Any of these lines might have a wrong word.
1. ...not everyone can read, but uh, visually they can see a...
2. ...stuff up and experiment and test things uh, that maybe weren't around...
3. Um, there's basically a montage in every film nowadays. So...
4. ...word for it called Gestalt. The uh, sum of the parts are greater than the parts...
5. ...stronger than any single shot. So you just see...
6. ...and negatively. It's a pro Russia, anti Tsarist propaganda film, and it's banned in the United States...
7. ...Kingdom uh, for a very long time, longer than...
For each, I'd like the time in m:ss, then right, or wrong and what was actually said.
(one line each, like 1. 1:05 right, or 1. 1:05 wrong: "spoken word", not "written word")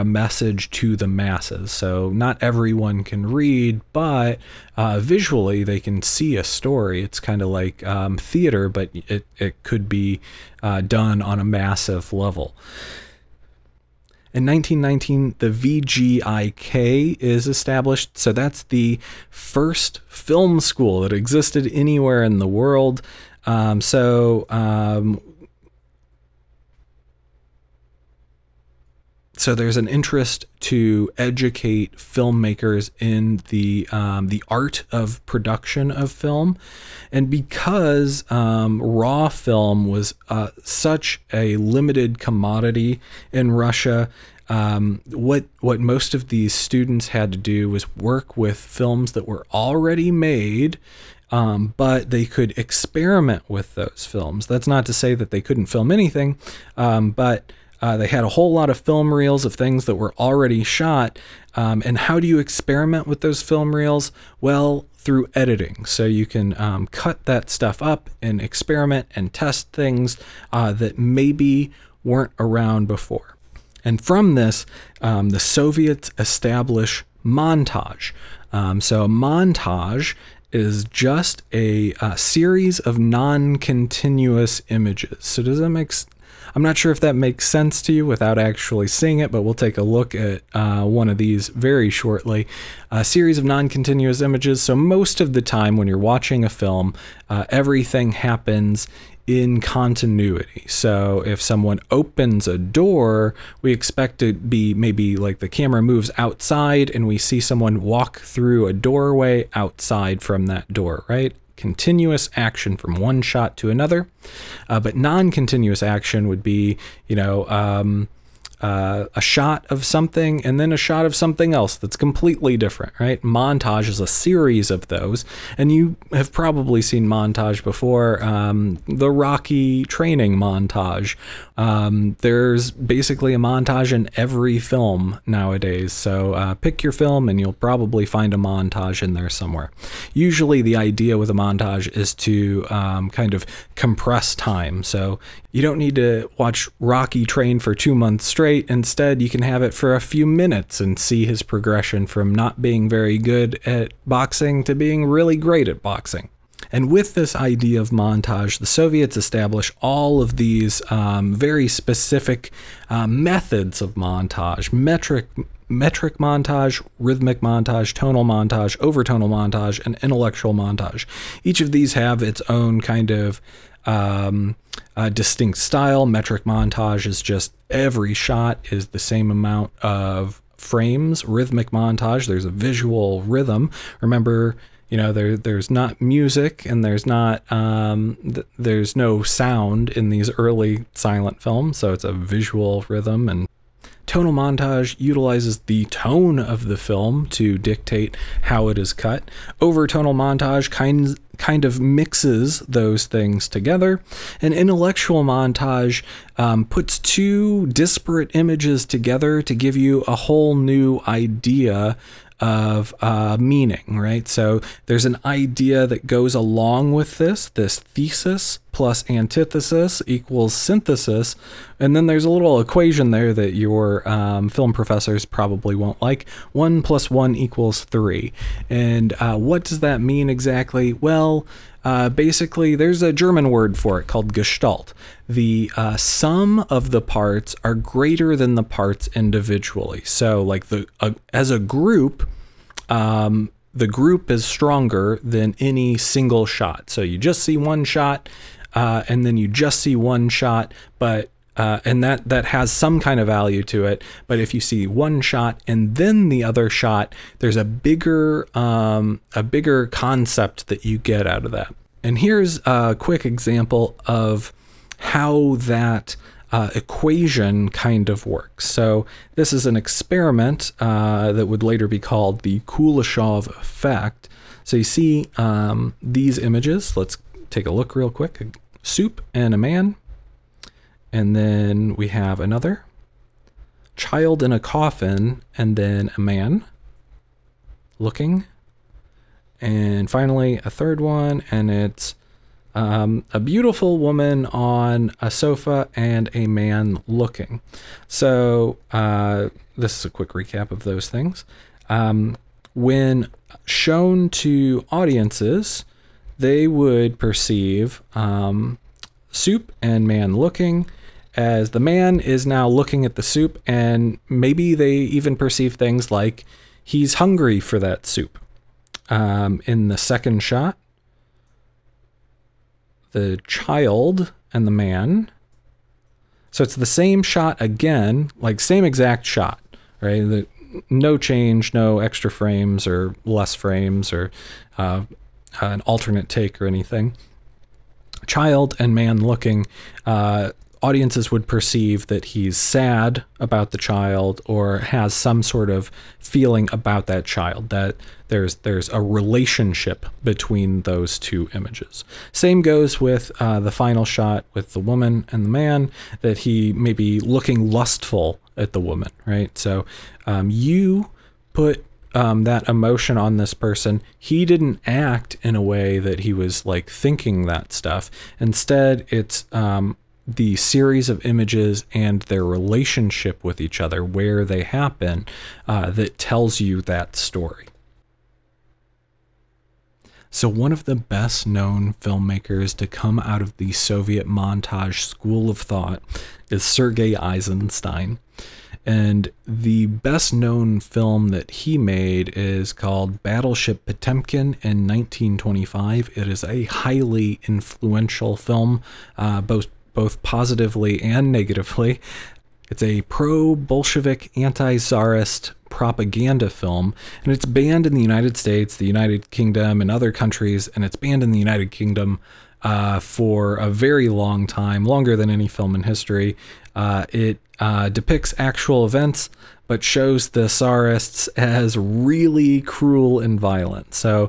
1. 0:02 right
2. 1:07 right
3. 2:11 right
4. 3:53 right
5. 4:04 right
6. 6:41 wrong: "Bolshevik", not "Russia"
7. 6:51 right.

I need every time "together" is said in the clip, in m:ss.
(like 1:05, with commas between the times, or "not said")
3:23, 3:28.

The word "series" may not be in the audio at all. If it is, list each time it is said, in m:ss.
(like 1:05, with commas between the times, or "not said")
1:22, 1:33, 2:04, 6:10.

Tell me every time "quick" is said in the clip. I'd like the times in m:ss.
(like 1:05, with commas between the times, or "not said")
4:22, 4:38, 5:00.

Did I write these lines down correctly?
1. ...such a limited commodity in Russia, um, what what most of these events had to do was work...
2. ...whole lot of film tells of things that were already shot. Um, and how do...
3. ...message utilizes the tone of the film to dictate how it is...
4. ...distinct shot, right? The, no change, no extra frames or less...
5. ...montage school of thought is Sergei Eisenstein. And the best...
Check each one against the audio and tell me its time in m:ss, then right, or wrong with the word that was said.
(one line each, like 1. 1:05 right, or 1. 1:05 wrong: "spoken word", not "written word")
1. 0:40 wrong: "students", not "events"
2. 0:58 wrong: "reels", not "tells"
3. 3:14 wrong: "montage", not "message"
4. 5:28 wrong: "exact", not "distinct"
5. 6:24 right.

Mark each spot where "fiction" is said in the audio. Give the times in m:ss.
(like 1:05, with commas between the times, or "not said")
not said.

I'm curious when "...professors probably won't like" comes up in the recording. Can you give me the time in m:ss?
3:44.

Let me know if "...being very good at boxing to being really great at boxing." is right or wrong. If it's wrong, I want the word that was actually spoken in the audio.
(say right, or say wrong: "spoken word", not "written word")
right.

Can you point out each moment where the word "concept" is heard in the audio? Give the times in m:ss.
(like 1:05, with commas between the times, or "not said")
4:19.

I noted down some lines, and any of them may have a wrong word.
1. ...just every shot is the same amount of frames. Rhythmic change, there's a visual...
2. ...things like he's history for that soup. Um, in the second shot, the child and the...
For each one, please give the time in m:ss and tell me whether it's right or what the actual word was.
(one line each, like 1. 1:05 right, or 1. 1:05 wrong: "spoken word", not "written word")
1. 2:57 wrong: "montage", not "change"
2. 5:15 wrong: "hungry", not "history".